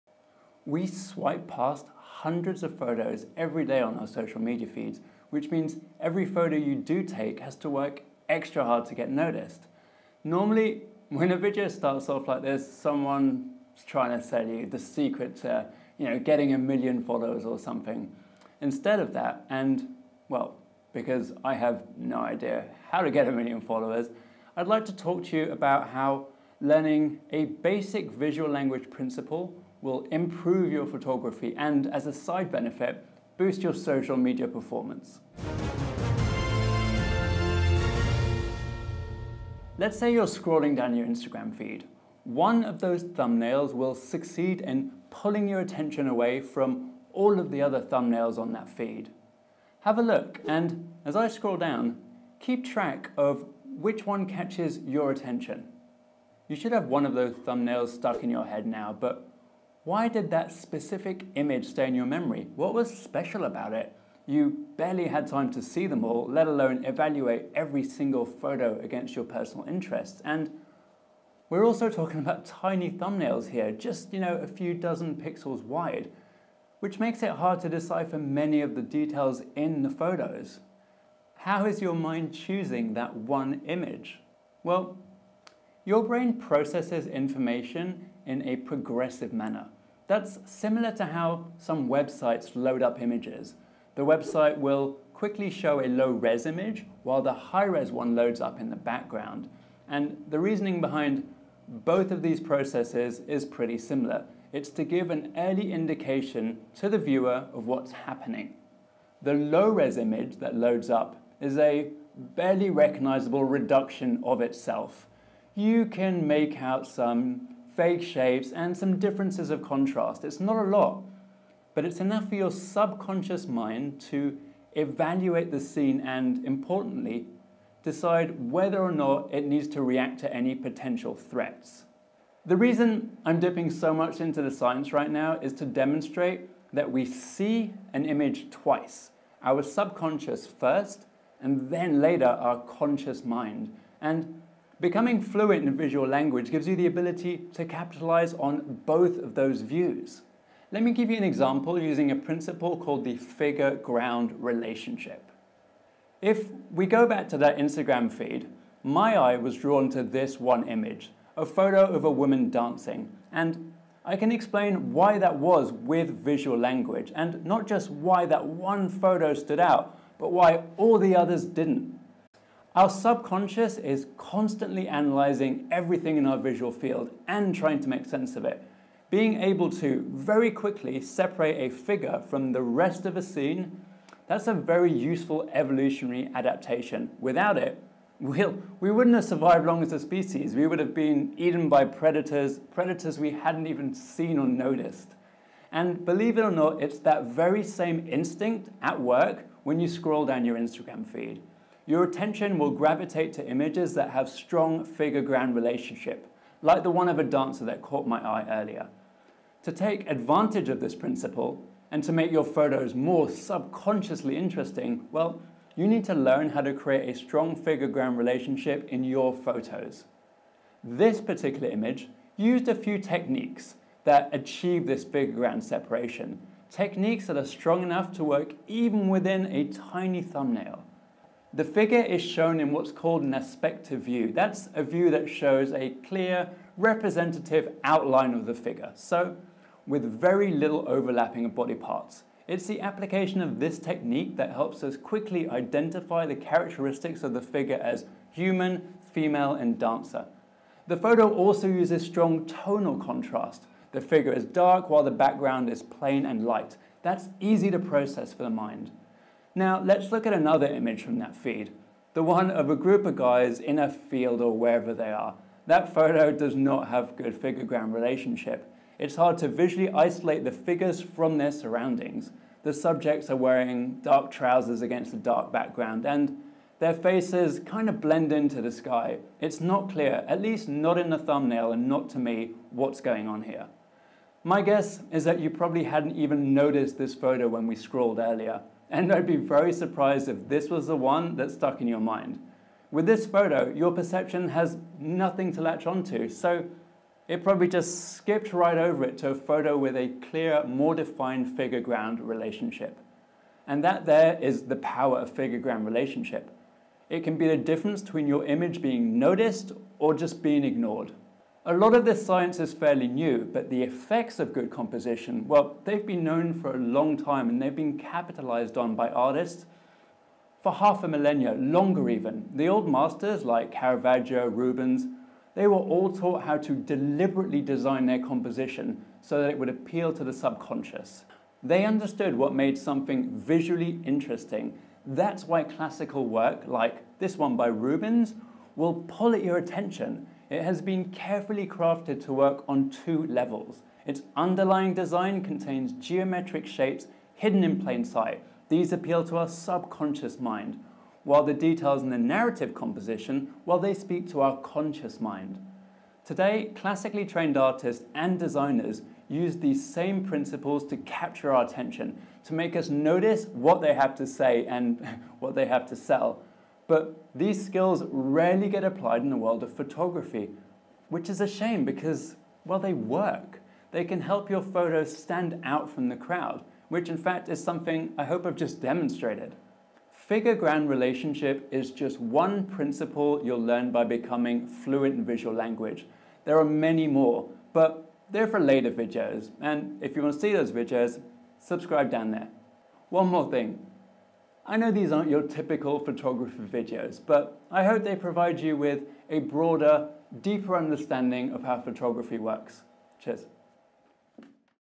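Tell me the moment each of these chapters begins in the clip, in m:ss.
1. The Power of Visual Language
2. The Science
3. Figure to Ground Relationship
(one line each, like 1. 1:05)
1. 0:39
2. 1:24
3. 2:34.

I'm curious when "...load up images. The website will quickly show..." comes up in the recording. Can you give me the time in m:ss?
1:32.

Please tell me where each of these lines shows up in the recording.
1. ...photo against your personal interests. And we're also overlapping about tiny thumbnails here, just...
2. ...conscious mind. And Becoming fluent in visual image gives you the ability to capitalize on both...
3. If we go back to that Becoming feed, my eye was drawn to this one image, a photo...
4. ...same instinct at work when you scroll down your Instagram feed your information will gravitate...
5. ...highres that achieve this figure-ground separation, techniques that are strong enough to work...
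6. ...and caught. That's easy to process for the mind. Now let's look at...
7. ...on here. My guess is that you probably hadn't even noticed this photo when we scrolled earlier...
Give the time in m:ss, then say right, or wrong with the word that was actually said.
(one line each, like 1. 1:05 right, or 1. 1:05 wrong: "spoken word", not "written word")
1. 1:08 wrong: "talking", not "overlapping"
2. 2:22 wrong: "language", not "image"
3. 2:36 wrong: "Instagram", not "Becoming"
4. 3:17 wrong: "attention", not "information"
5. 3:42 wrong: "techniques", not "highres"
6. 4:16 wrong: "light", not "caught"
7. 4:43 right.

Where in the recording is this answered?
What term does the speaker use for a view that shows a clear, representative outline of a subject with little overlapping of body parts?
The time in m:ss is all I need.
3:53.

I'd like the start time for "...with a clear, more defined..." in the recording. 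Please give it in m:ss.
4:59.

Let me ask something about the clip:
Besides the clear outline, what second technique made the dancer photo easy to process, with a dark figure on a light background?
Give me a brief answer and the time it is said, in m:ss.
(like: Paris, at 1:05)
tonal contrast, at 4:12.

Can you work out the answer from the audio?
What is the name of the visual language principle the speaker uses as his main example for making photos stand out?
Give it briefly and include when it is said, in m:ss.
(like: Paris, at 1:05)
figure ground relationship, at 2:33.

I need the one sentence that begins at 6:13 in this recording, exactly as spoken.
They can help your photos stand out from the crowd, which in fact is something I hope I've just demonstrated.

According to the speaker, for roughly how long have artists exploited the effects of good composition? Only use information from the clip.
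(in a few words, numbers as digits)
half a millennia.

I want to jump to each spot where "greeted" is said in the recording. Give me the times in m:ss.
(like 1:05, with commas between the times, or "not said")
not said.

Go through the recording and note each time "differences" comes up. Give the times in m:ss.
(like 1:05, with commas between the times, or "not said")
1:58, 5:07.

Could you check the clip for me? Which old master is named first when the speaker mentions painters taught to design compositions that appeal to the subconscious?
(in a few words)
Caravaggio.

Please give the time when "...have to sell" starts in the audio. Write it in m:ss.
6:05.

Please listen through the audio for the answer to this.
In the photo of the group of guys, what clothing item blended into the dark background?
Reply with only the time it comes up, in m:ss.
4:34.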